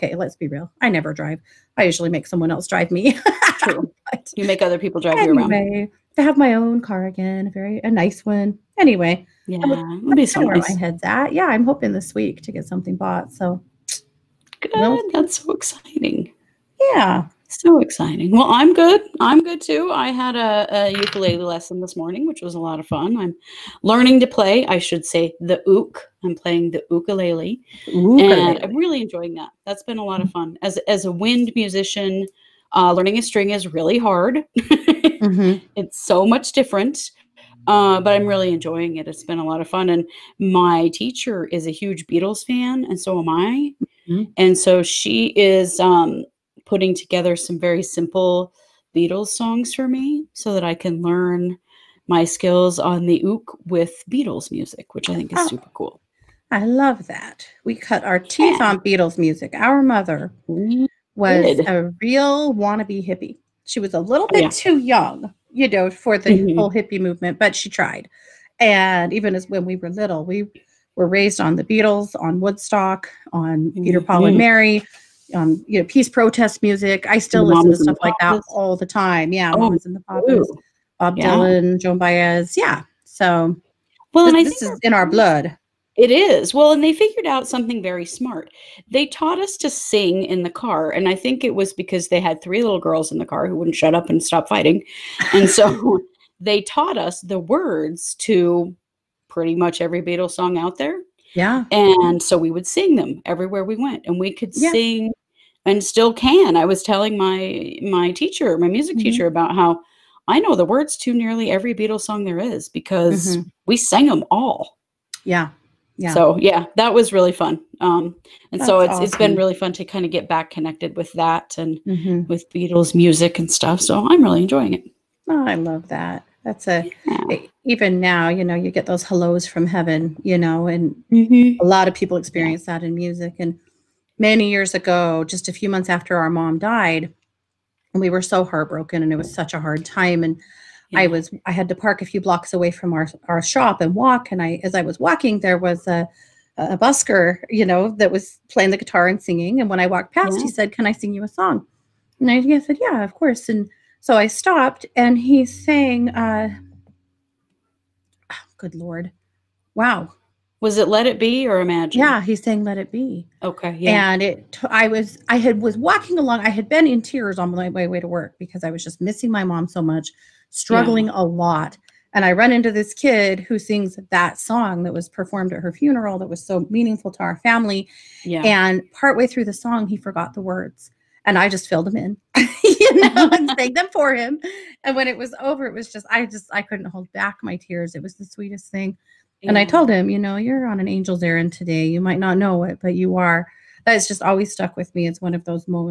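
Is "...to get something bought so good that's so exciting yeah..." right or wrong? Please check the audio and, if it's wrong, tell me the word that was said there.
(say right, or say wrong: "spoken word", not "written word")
right.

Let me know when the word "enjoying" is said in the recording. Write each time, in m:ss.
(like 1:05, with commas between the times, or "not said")
0:29, 0:38, 2:04.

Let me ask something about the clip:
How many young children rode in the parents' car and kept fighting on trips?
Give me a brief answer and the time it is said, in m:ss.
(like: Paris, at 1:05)
3, at 1:32.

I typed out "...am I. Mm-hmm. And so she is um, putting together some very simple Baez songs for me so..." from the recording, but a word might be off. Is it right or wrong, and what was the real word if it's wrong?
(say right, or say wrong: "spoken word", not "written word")
wrong: "Beatles", not "Baez".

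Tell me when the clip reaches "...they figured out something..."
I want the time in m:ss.
1:26.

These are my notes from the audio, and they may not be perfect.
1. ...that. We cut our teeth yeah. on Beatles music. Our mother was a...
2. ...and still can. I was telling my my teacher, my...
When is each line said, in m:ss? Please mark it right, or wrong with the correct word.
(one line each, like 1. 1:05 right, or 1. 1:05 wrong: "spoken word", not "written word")
1. 0:57 right
2. 1:45 right.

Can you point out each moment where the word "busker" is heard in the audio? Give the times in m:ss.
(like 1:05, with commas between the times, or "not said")
2:26.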